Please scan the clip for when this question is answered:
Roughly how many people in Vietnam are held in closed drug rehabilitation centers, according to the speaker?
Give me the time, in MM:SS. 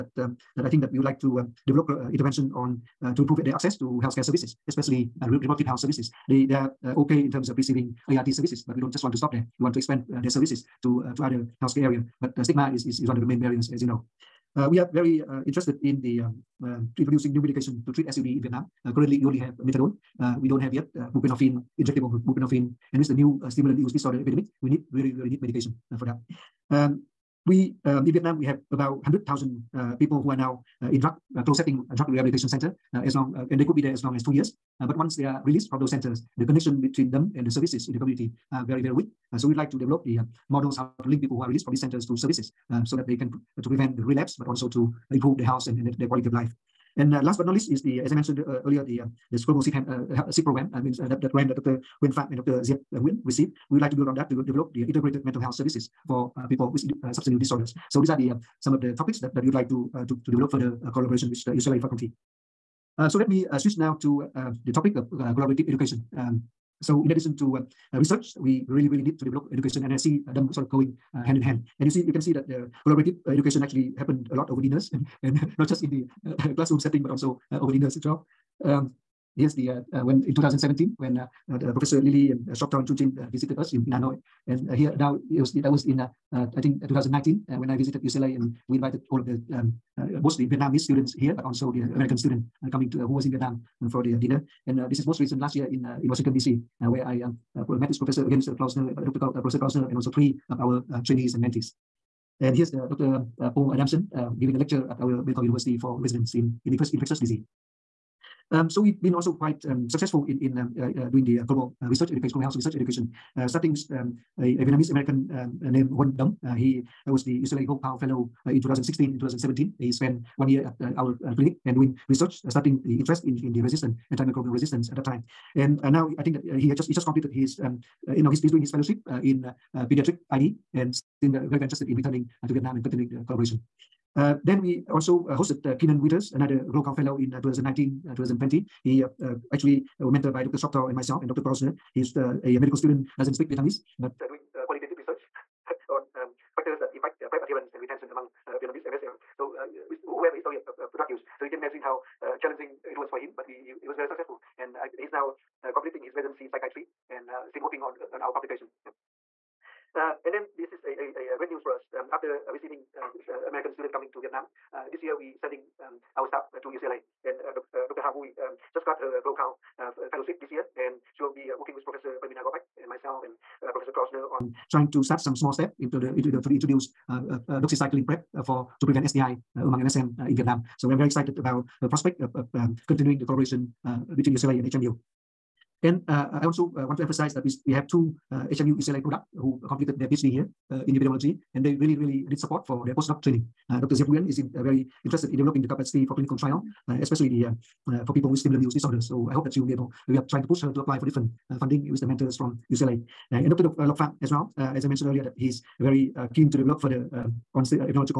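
00:29.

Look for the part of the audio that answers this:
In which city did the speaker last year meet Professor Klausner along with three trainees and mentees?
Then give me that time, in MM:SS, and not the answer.
01:36.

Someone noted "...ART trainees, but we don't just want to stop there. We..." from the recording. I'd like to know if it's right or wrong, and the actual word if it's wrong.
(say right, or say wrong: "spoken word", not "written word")
wrong: "services", not "trainees".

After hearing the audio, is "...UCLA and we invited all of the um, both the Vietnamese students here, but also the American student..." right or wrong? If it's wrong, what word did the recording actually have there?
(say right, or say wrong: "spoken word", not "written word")
right.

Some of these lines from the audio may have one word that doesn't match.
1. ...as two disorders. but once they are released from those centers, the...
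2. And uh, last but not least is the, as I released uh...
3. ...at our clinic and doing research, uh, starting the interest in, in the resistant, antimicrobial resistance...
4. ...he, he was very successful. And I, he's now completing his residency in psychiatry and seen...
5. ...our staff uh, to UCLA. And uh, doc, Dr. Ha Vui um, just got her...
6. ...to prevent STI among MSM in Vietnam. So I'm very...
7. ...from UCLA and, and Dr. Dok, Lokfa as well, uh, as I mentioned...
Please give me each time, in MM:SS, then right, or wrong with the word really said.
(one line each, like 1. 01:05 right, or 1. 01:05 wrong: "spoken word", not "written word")
1. 00:34 wrong: "years", not "disorders"
2. 00:46 wrong: "mentioned", not "released"
3. 02:00 right
4. 02:33 right
5. 02:46 right
6. 02:58 right
7. 03:22 right.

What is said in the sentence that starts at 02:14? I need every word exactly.
Uh, then we also uh, hosted uh, Keenan Withers, another Global Fellow in uh, 2019, 2020.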